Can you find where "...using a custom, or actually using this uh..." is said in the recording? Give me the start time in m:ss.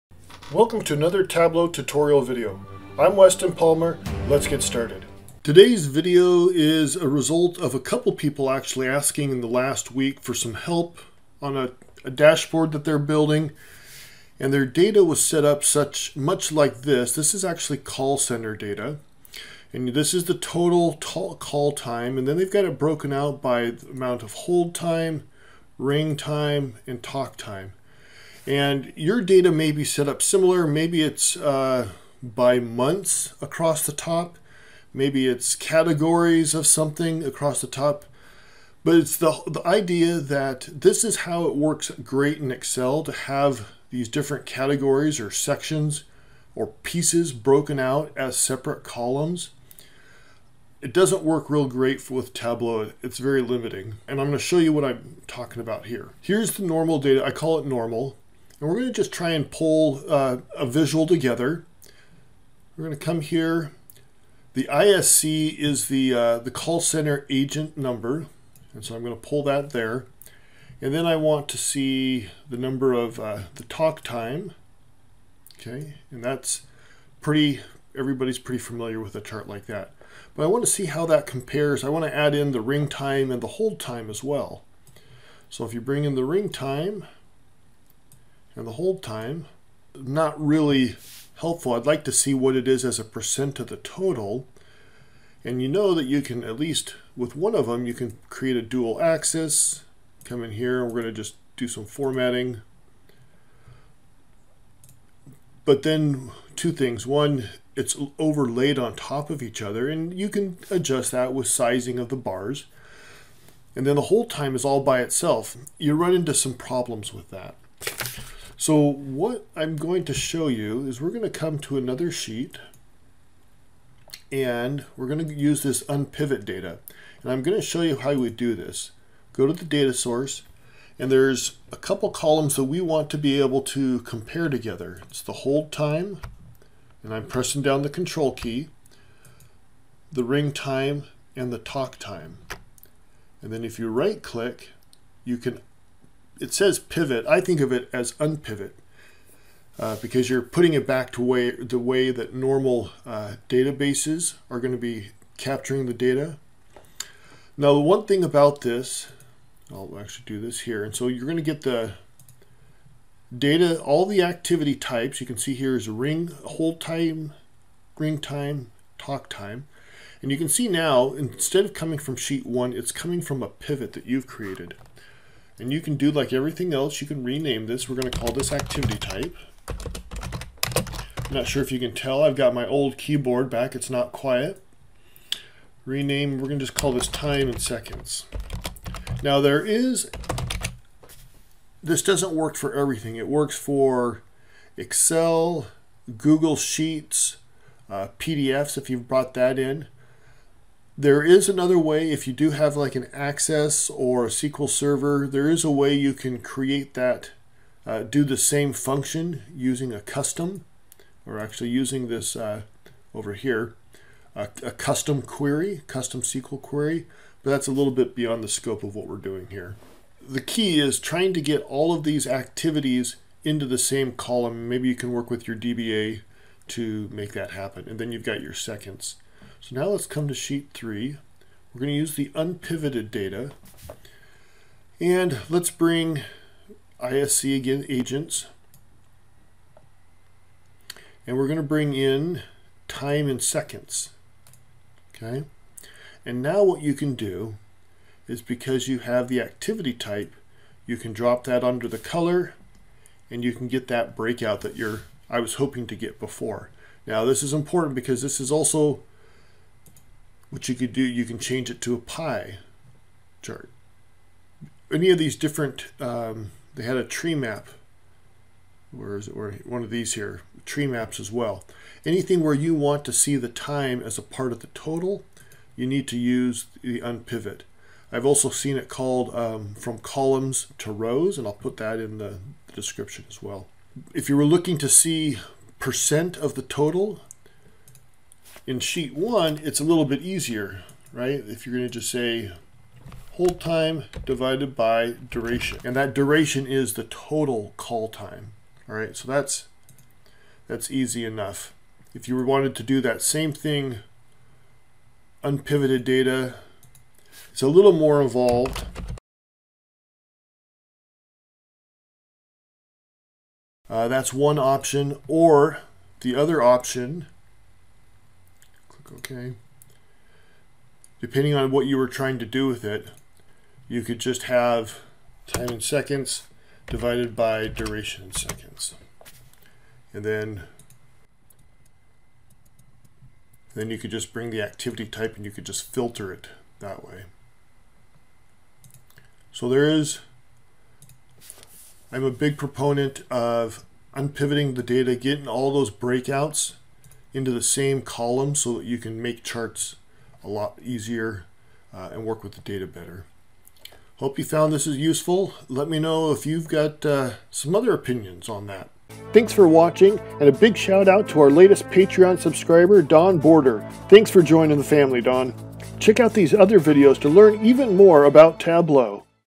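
3:29.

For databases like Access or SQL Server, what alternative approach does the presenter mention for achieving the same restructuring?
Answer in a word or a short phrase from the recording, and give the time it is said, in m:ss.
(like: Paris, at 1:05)
Custom SQL query, at 3:35.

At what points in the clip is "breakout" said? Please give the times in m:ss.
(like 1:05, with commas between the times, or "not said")
4:14, 5:45.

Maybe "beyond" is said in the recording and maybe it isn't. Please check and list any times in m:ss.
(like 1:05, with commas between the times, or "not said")
3:38.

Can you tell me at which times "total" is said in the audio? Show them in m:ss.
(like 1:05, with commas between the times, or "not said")
0:20, 1:33, 4:34, 4:46, 4:57.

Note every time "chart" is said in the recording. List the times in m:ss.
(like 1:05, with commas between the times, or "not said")
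1:19, 4:23, 5:49.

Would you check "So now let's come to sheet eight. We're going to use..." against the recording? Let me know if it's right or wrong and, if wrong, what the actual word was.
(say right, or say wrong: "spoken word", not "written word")
wrong: "three", not "eight".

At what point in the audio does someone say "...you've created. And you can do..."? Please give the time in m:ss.
2:54.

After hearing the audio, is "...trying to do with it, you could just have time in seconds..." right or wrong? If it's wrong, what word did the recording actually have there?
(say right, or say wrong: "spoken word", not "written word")
right.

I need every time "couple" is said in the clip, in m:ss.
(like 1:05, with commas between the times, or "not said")
0:07, 2:11.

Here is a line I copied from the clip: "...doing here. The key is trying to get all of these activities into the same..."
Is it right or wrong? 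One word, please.
right.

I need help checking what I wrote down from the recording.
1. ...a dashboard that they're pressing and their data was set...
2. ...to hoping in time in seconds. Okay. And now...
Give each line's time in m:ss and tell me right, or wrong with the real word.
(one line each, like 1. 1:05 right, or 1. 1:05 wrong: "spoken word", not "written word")
1. 0:12 wrong: "building", not "pressing"
2. 4:01 wrong: "bring", not "hoping".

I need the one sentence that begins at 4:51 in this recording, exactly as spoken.
If you're going to just say hold time divided by duration.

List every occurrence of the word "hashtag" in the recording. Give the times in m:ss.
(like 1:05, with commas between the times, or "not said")
not said.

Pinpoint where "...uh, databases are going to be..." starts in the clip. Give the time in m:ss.
2:33.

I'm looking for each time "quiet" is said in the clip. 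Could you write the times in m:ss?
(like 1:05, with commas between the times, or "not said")
3:04.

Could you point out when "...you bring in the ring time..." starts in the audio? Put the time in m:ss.
1:25.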